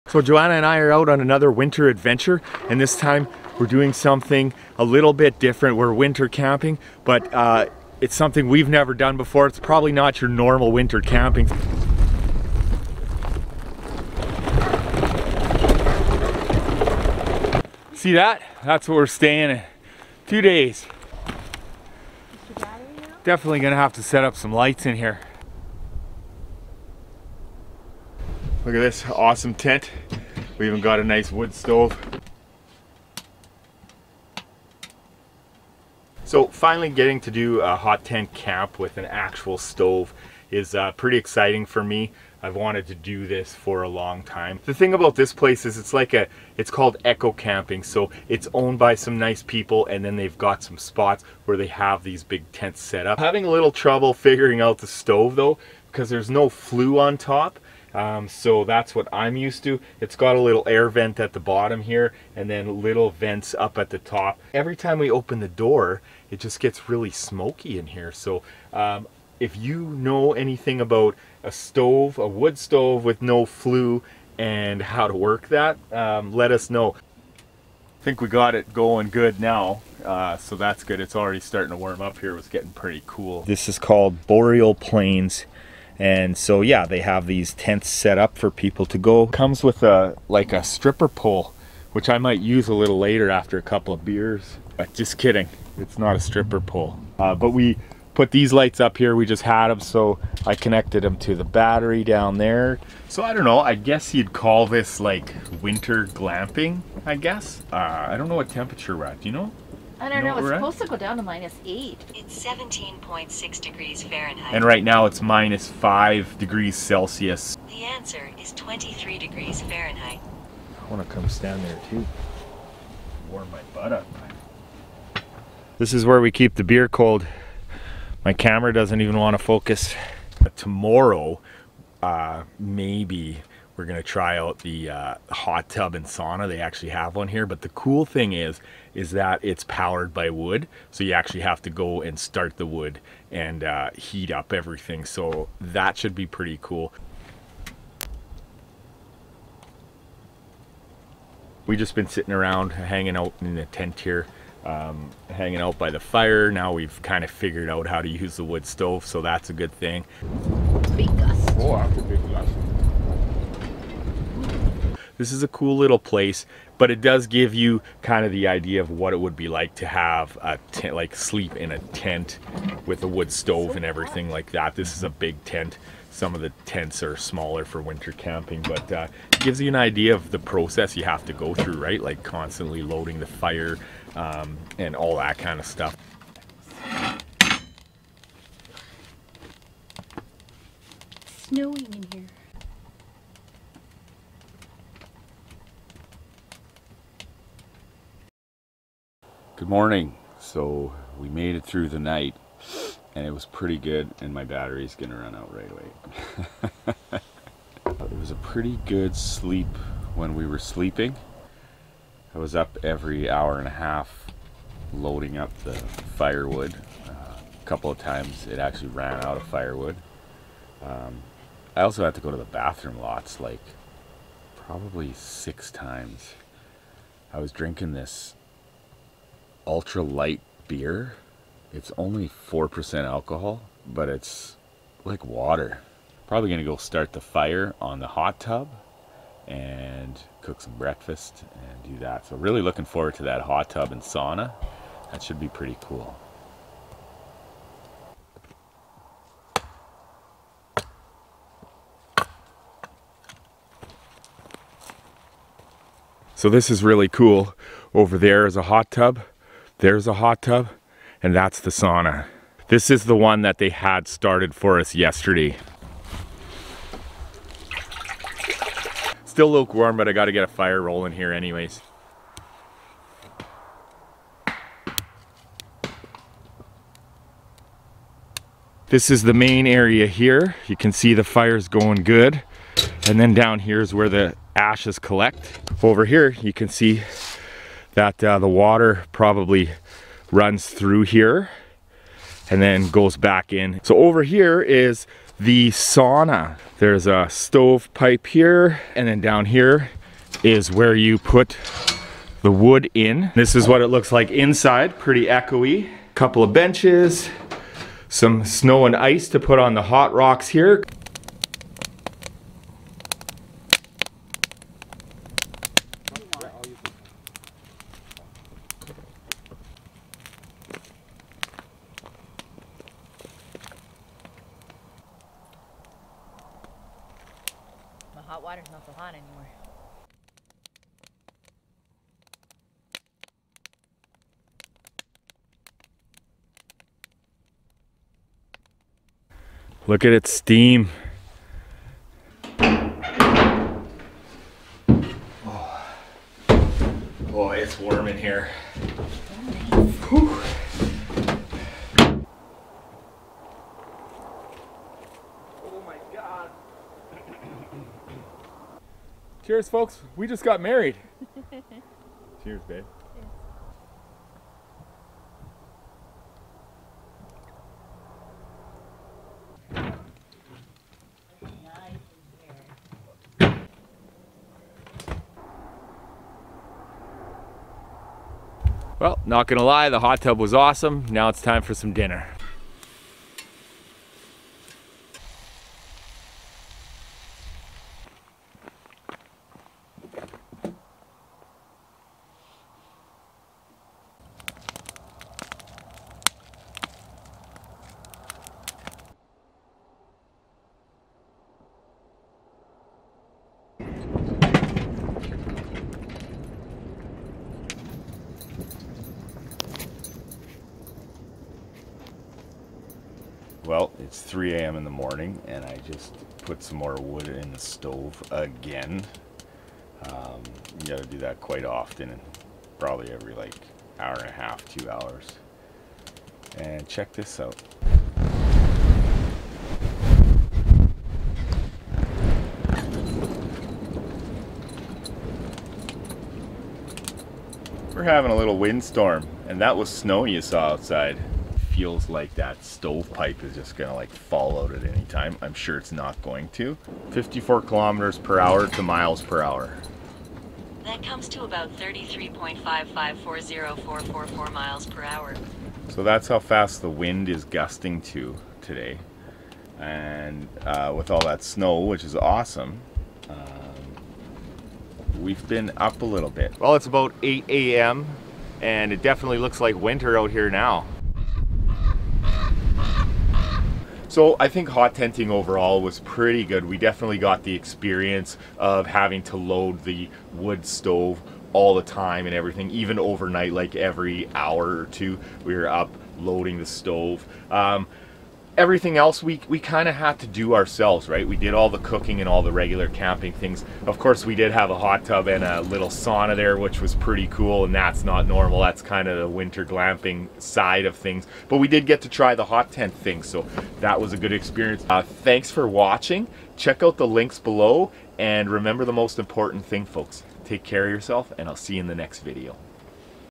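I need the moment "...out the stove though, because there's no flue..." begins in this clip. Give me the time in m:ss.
0:54.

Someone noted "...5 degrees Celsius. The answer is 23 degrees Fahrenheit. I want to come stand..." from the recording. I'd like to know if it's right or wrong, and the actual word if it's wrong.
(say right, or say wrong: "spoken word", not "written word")
right.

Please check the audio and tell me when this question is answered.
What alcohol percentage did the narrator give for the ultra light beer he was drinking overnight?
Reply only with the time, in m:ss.
3:52.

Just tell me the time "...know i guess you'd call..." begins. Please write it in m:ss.
1:43.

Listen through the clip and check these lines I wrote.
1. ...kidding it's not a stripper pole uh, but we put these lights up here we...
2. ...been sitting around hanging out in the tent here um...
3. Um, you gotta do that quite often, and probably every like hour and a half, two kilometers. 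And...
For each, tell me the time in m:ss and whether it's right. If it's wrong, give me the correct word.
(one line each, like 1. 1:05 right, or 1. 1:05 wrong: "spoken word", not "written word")
1. 1:35 right
2. 2:31 right
3. 7:00 wrong: "hours", not "kilometers".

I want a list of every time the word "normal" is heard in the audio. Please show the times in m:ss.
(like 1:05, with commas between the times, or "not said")
0:10, 8:18.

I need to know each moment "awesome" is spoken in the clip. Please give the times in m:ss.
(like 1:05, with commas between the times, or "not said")
0:29, 6:20, 7:42.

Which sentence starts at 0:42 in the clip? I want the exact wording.
I've wanted to do this for a long time.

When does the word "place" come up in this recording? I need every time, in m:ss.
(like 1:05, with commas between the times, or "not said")
0:45, 2:45.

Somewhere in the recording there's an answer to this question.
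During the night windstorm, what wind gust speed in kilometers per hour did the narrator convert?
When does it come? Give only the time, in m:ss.
7:27.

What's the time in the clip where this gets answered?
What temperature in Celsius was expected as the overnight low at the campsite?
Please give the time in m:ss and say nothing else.
1:51.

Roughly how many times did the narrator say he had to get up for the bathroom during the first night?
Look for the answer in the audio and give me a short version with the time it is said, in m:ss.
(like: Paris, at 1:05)
6, at 3:45.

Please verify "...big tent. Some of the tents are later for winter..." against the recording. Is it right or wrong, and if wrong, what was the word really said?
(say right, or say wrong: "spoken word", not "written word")
wrong: "smaller", not "later".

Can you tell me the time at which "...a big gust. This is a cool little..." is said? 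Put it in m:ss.
2:41.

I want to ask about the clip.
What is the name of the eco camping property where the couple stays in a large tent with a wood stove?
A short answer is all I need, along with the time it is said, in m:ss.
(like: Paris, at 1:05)
Boreal Plains, at 1:24.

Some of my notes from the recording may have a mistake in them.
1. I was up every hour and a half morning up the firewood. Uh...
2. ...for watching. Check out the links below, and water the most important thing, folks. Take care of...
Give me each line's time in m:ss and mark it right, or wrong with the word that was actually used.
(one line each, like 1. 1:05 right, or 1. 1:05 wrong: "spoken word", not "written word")
1. 3:32 wrong: "loading", not "morning"
2. 8:25 wrong: "remember", not "water".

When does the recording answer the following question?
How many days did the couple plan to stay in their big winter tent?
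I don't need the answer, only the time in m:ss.
0:20.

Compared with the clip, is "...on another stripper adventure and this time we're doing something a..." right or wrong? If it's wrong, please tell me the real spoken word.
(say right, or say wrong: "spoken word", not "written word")
wrong: "winter", not "stripper".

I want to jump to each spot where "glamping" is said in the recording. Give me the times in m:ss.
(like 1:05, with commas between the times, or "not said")
1:46, 8:19.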